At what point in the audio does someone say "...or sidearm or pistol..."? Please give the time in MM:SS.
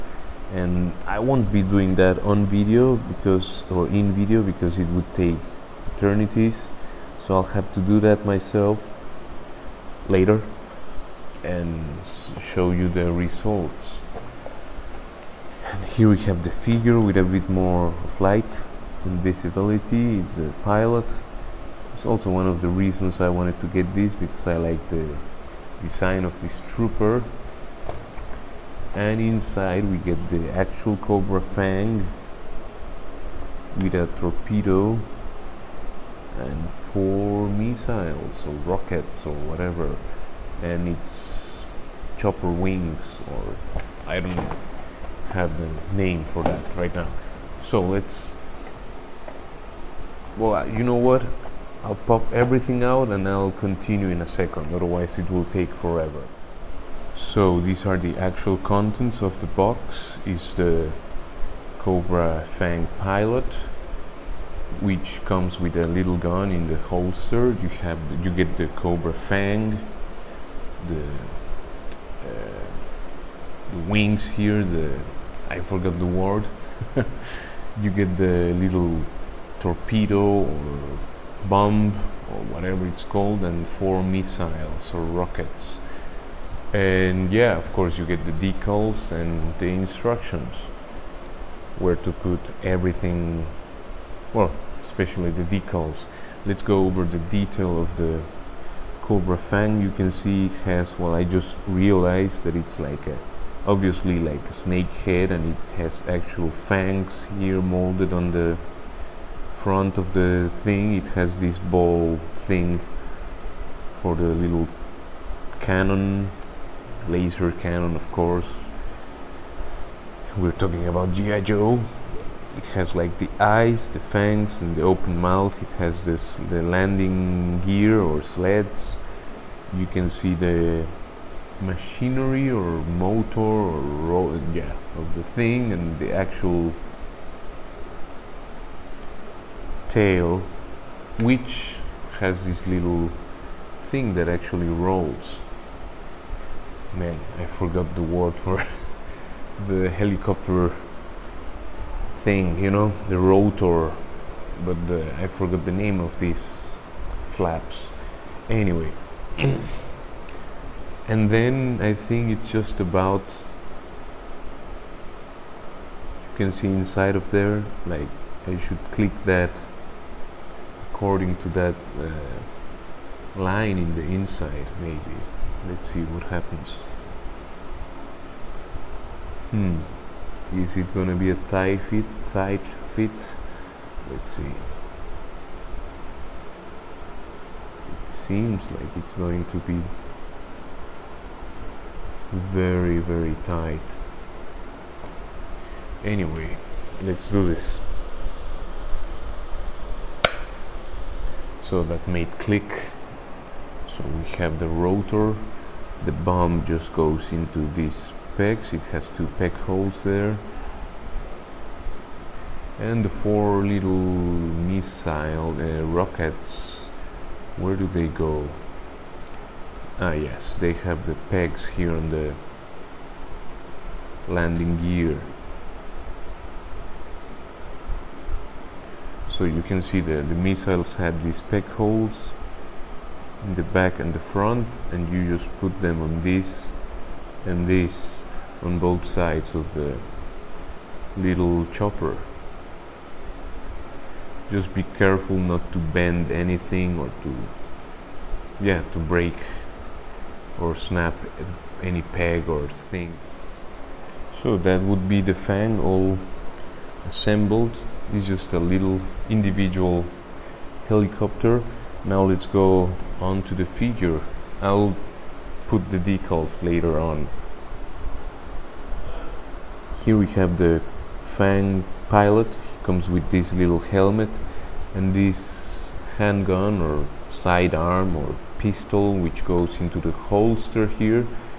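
04:36.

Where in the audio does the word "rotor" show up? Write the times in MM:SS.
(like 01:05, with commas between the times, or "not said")
02:33, 03:24.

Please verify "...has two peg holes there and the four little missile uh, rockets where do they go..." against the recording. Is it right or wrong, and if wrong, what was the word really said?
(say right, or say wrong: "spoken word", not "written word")
right.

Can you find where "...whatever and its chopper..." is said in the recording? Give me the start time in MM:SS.
00:39.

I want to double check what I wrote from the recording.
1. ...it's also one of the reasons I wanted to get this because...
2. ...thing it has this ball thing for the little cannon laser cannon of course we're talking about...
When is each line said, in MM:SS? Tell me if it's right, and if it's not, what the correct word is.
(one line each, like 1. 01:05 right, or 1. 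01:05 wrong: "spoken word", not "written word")
1. 00:21 right
2. 01:50 right.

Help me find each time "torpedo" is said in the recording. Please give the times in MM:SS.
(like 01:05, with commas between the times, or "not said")
00:34, 01:19.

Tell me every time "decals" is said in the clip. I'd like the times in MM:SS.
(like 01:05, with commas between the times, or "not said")
01:28, 01:35, 04:25.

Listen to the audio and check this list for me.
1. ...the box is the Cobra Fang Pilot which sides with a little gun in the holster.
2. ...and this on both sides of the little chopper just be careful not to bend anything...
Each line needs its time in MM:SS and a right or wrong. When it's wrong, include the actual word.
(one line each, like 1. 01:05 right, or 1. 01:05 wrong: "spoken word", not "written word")
1. 00:59 wrong: "comes", not "sides"
2. 03:57 right.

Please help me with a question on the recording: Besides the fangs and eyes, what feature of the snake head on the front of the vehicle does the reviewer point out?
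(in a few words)
open mouth.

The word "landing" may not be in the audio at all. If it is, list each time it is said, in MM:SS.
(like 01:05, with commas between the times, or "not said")
02:06, 03:44.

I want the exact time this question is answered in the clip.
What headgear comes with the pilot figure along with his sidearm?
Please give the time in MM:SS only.
04:33.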